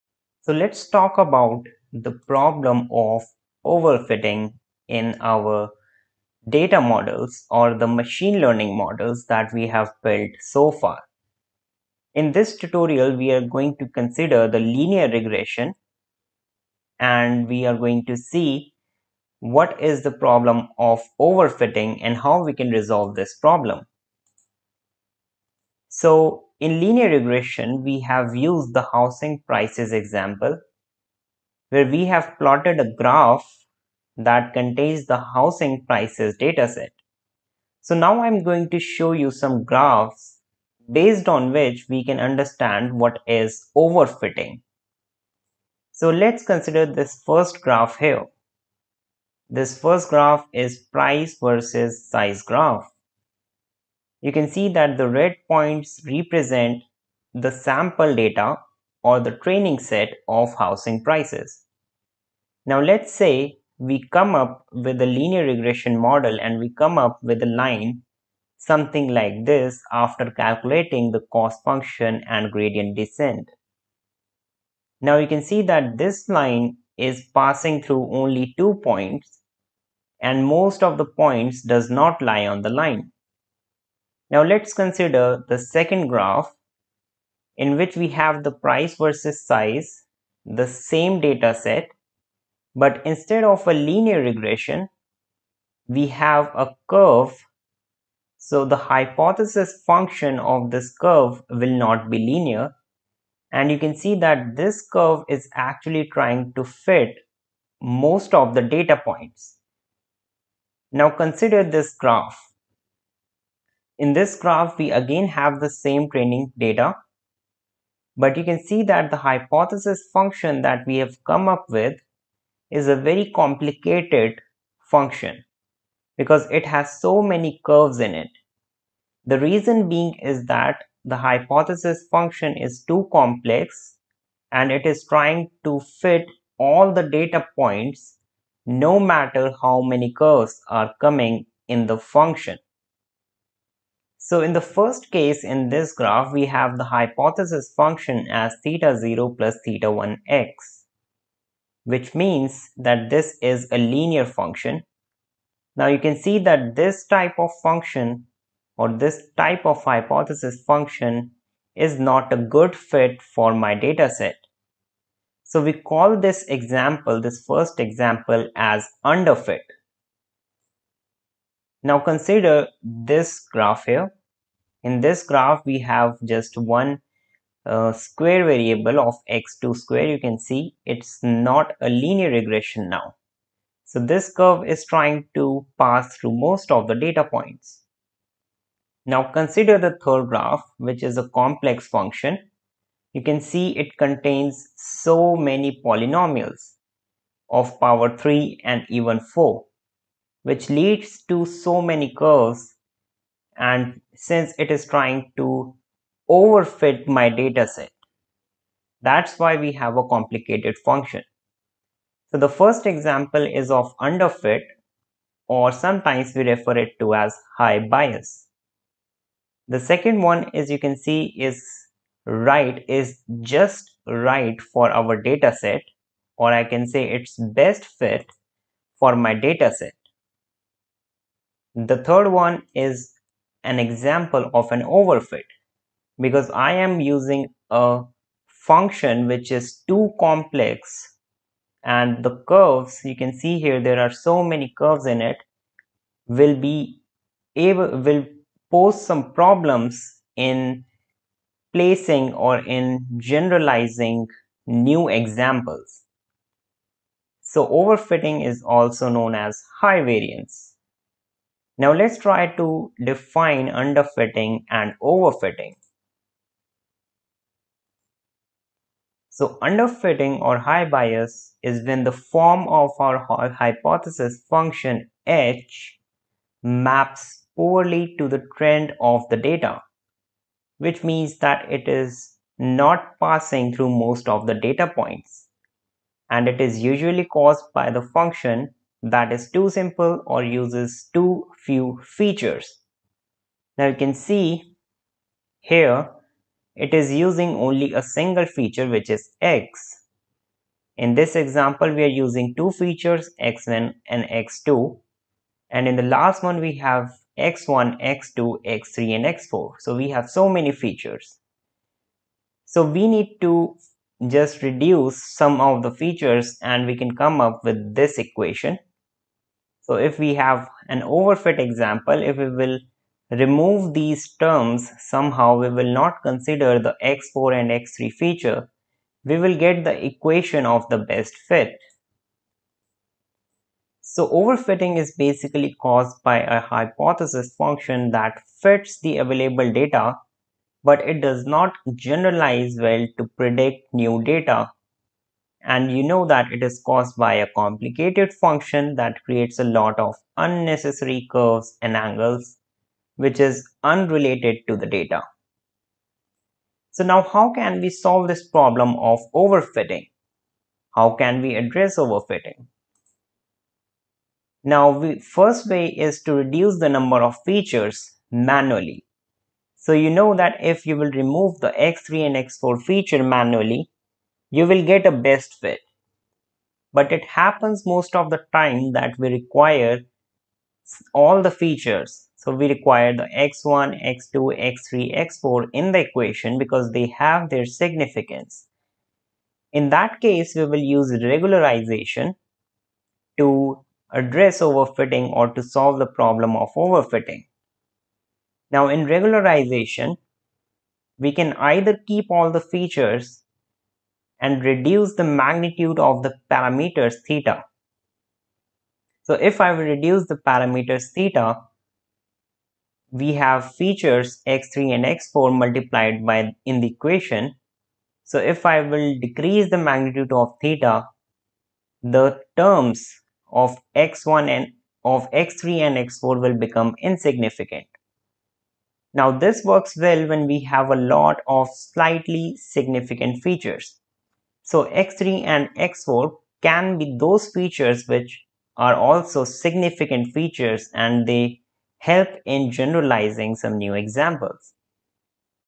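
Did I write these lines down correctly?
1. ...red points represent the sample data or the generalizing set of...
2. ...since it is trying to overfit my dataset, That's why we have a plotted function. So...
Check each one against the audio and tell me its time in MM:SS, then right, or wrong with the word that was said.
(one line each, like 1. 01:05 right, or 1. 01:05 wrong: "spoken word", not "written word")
1. 00:55 wrong: "training", not "generalizing"
2. 03:24 wrong: "complicated", not "plotted".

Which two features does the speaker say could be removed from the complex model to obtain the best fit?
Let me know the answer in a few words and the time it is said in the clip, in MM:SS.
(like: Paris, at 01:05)
x3 and x4, at 05:27.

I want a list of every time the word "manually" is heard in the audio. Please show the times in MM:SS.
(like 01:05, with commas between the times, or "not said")
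06:08, 06:13.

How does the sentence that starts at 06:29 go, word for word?
In that case, we will use regularization to address overfitting or to solve the problem of overfitting.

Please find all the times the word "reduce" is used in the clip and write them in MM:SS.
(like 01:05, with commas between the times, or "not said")
05:14, 06:06, 06:44, 06:49.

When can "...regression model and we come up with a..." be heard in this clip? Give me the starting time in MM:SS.
01:05.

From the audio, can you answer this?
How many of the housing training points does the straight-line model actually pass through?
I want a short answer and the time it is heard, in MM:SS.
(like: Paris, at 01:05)
2, at 01:18.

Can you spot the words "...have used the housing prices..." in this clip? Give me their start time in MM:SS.
00:27.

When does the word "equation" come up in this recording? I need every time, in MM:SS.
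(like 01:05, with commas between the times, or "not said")
05:18, 05:30, 06:25, 06:56.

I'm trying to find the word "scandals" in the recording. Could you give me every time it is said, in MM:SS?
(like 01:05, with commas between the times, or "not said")
not said.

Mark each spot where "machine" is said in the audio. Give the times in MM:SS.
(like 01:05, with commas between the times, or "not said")
00:07.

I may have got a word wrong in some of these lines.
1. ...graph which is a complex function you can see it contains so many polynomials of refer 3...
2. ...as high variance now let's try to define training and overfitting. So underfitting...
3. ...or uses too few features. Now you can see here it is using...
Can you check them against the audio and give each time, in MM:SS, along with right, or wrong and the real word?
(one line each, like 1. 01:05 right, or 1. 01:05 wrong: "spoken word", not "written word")
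1. 03:10 wrong: "power", not "refer"
2. 04:19 wrong: "underfitting", not "training"
3. 04:50 right.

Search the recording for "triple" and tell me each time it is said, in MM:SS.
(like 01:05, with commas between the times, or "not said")
not said.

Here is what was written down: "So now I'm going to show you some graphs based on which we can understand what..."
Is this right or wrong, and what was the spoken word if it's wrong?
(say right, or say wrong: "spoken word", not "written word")
right.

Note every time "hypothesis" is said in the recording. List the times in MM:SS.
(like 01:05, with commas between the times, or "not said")
01:38, 01:59, 02:11, 02:26, 02:39, 04:33, 05:36.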